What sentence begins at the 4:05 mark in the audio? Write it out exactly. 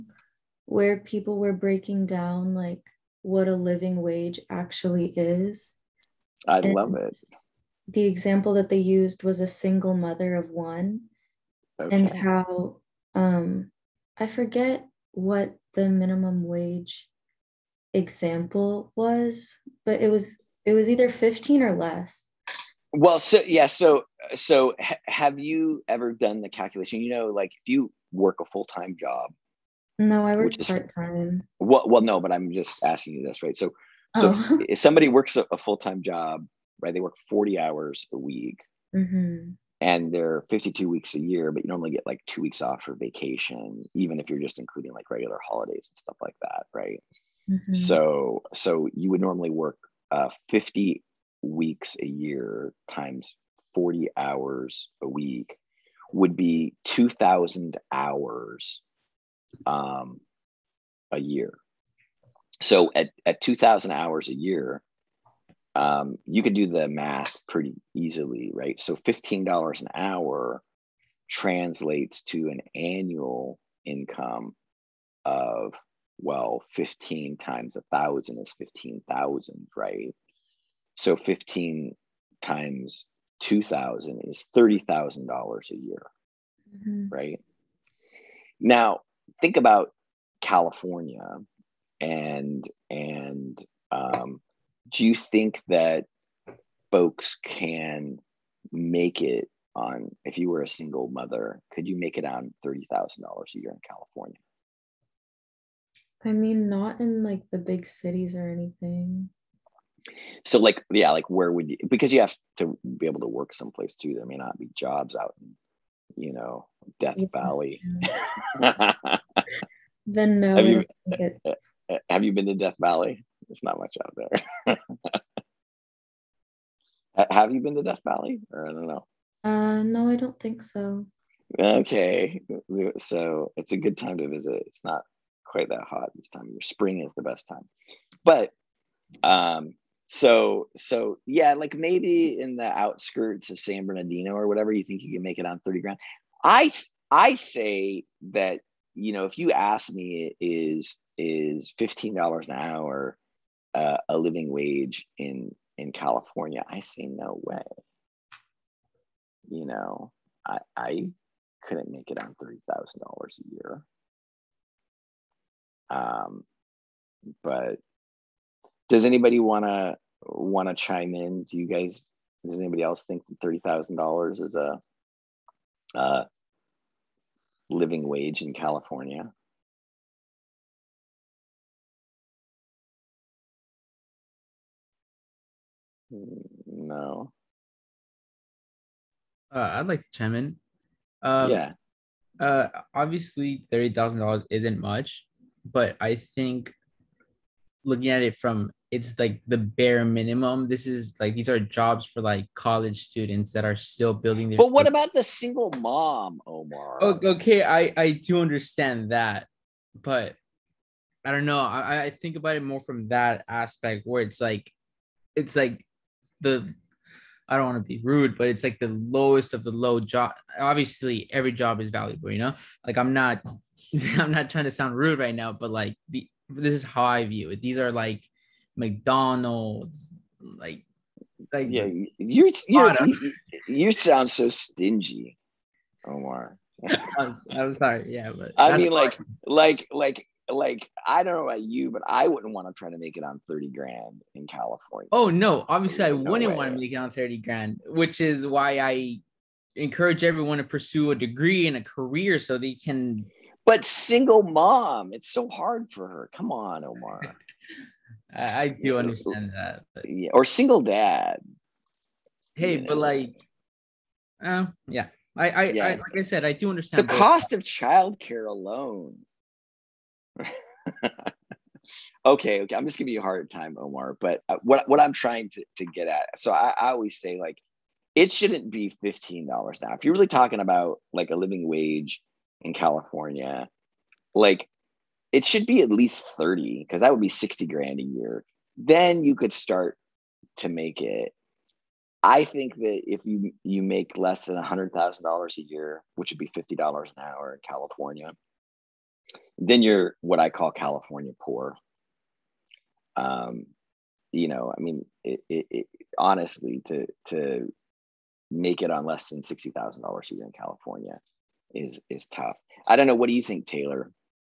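Oh no, obviously There's I no wouldn't way.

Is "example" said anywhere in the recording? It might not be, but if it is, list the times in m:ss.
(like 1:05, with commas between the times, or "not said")
0:08, 0:17.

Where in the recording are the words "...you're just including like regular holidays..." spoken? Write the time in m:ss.
0:44.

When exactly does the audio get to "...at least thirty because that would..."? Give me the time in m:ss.
4:45.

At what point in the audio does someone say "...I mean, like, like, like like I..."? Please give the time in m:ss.
3:58.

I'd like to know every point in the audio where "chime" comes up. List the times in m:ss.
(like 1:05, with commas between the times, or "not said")
2:50, 3:10.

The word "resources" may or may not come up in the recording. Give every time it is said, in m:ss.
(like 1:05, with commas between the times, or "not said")
not said.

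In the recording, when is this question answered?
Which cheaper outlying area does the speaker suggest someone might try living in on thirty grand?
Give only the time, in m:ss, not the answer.
2:23.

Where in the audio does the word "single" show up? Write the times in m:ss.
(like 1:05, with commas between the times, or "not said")
0:09, 1:40, 3:25, 4:13, 4:20.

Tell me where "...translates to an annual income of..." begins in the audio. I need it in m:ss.
1:11.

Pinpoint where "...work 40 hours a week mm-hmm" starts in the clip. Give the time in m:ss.
0:36.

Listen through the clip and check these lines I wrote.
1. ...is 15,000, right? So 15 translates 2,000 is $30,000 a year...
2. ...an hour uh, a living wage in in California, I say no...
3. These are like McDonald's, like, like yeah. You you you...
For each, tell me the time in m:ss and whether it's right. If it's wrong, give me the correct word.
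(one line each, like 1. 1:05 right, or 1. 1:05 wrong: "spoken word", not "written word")
1. 1:18 wrong: "times", not "translates"
2. 2:32 right
3. 3:47 right.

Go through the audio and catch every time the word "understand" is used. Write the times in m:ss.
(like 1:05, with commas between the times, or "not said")
3:28, 4:18, 4:26.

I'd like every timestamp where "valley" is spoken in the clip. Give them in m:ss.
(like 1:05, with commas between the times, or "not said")
1:57, 2:02, 2:08.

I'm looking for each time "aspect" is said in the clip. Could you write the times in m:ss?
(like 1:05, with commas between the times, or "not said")
3:33.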